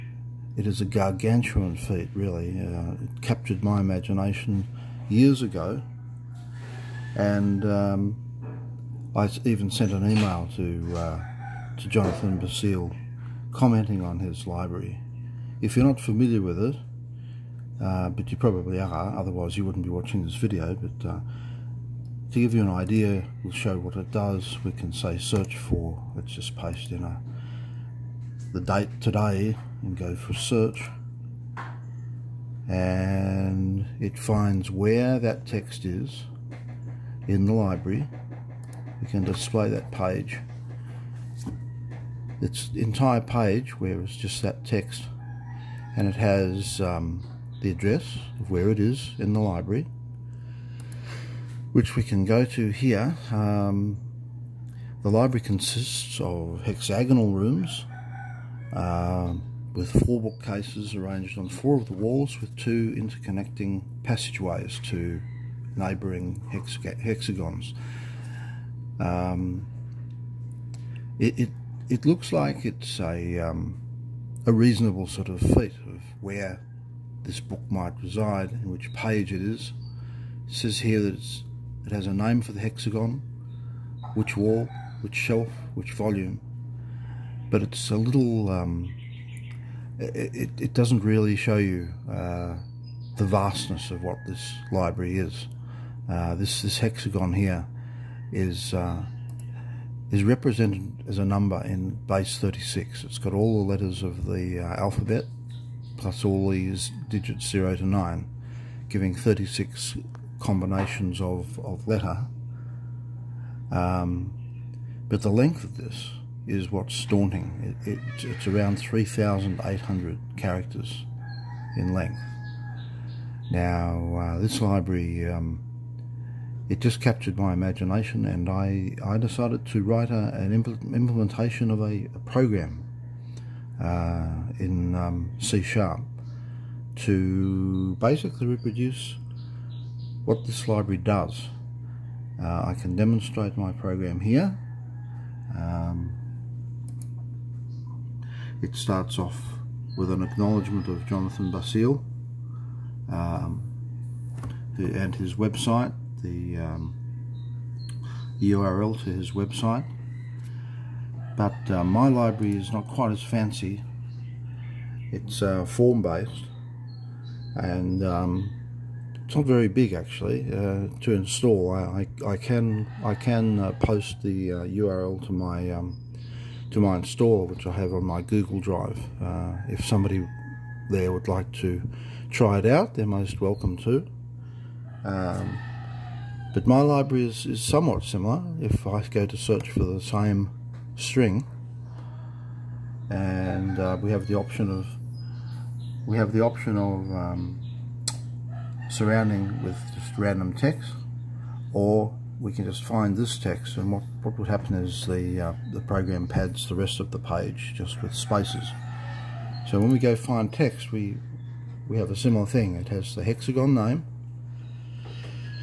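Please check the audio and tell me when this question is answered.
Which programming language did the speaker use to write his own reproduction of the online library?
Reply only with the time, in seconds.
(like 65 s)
135 s.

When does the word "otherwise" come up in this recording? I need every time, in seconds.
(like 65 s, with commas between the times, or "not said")
19 s.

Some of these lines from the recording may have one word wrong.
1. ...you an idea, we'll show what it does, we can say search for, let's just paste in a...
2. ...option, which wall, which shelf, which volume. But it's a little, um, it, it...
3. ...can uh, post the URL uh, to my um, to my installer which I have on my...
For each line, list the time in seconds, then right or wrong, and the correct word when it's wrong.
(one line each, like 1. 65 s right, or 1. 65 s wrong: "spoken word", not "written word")
1. 22 s right
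2. 82 s wrong: "hexagon", not "option"
3. 173 s right.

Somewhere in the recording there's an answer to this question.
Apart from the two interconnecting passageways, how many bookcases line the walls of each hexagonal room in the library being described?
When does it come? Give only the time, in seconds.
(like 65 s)
60 s.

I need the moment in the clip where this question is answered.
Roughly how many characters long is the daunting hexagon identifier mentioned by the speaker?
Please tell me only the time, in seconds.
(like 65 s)
118 s.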